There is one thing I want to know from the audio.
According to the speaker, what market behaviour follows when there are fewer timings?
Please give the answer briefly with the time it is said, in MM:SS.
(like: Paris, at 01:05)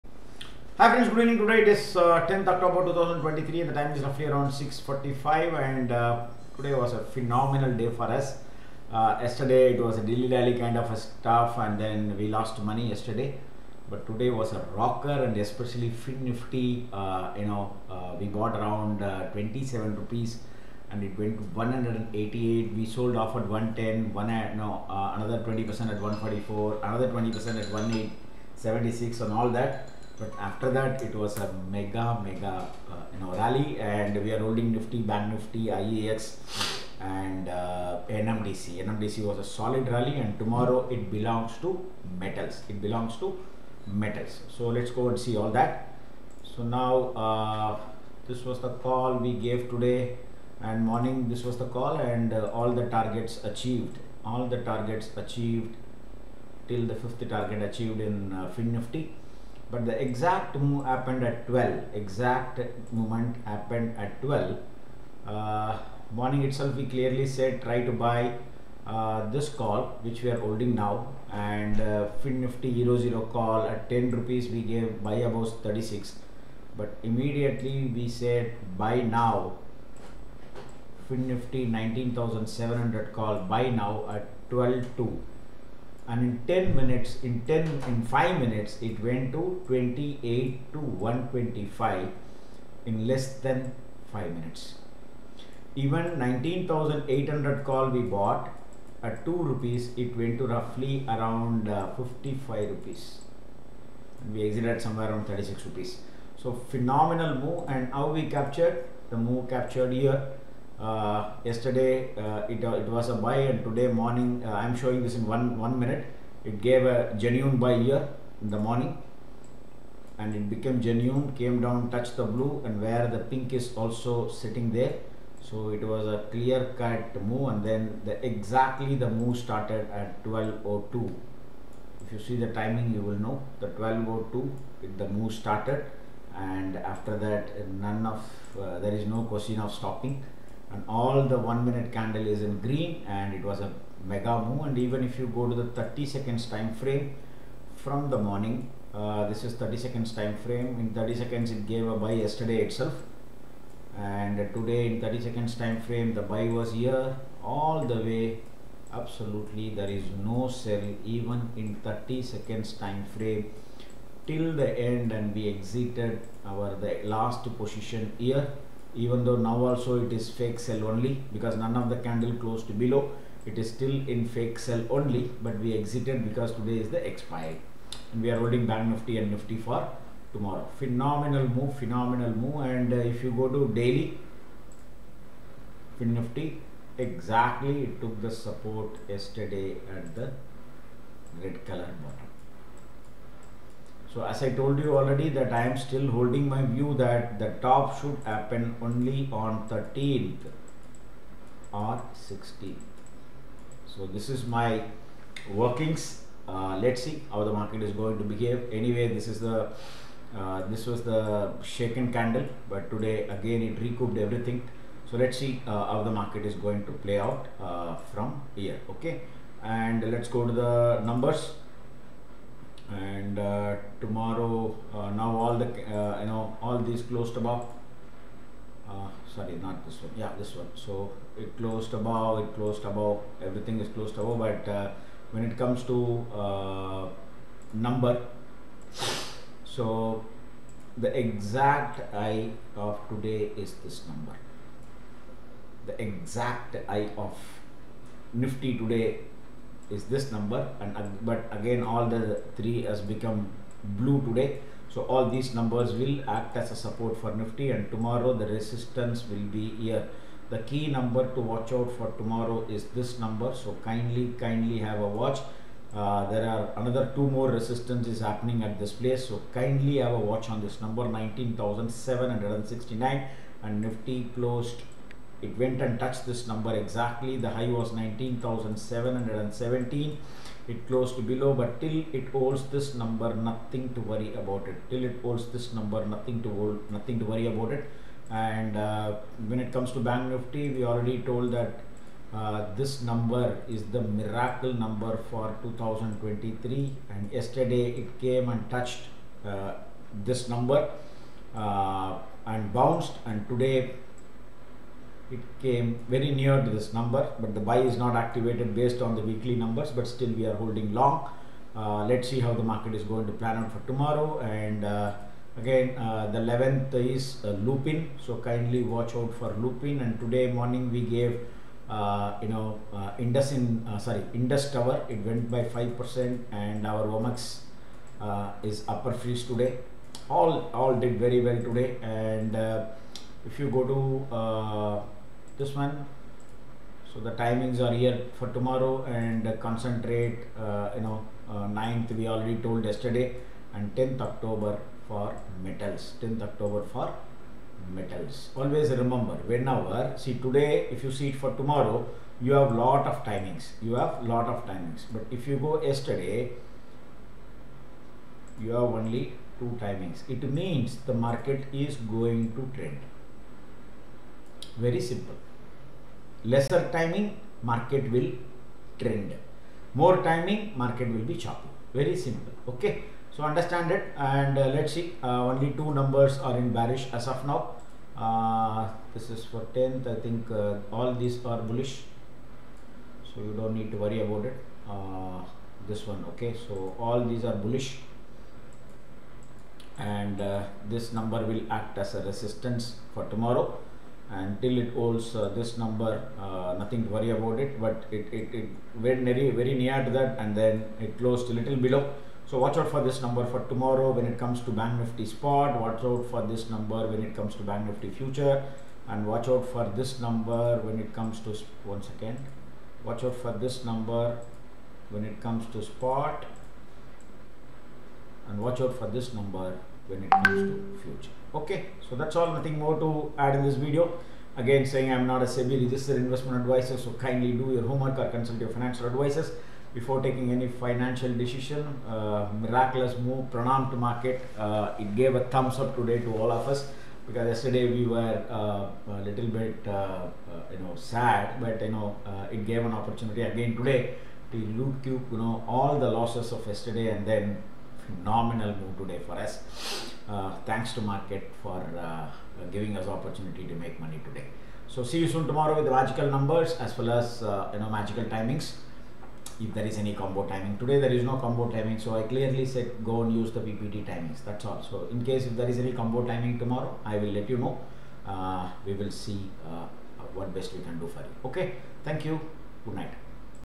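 market will trend, at 06:07.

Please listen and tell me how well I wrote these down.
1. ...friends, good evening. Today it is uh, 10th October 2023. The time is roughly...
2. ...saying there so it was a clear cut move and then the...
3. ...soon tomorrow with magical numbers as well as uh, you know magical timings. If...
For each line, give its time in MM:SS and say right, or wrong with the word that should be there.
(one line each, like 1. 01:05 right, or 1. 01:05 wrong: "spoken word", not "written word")
1. 00:00 right
2. 02:04 wrong: "sitting", not "saying"
3. 07:35 right.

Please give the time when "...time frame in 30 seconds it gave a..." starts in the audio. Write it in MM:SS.
02:30.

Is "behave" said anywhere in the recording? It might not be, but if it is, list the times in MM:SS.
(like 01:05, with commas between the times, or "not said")
03:28.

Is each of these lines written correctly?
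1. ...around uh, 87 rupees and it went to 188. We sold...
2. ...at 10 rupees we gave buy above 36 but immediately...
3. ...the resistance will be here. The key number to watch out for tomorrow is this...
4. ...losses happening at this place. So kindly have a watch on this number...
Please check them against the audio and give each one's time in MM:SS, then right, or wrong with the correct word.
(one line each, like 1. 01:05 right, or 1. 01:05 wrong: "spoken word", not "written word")
1. 00:18 wrong: "27", not "87"
2. 01:13 right
3. 04:18 right
4. 04:27 wrong: "resistances", not "losses".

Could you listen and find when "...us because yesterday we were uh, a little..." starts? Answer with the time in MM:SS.
07:16.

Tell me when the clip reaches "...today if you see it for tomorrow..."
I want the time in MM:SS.
05:50.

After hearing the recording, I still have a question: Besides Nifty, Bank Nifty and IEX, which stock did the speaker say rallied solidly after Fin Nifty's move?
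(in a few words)
NMDC.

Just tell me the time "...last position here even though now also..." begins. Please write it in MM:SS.
02:47.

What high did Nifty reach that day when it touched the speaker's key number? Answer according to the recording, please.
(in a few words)
19717.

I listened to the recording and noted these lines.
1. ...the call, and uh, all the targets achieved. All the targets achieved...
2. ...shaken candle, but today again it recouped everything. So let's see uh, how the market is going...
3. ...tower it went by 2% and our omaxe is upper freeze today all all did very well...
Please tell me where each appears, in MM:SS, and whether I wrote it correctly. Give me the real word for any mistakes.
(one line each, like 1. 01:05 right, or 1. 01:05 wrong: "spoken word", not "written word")
1. 00:51 right
2. 03:31 right
3. 05:24 wrong: "5", not "2".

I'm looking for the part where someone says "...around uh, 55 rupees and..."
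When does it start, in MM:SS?
01:41.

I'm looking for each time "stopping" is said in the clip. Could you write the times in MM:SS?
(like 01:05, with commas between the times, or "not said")
02:19.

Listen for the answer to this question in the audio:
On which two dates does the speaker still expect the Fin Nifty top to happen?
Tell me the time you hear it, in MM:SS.
03:19.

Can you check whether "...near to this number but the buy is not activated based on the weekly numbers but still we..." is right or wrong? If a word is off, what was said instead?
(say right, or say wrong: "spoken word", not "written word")
right.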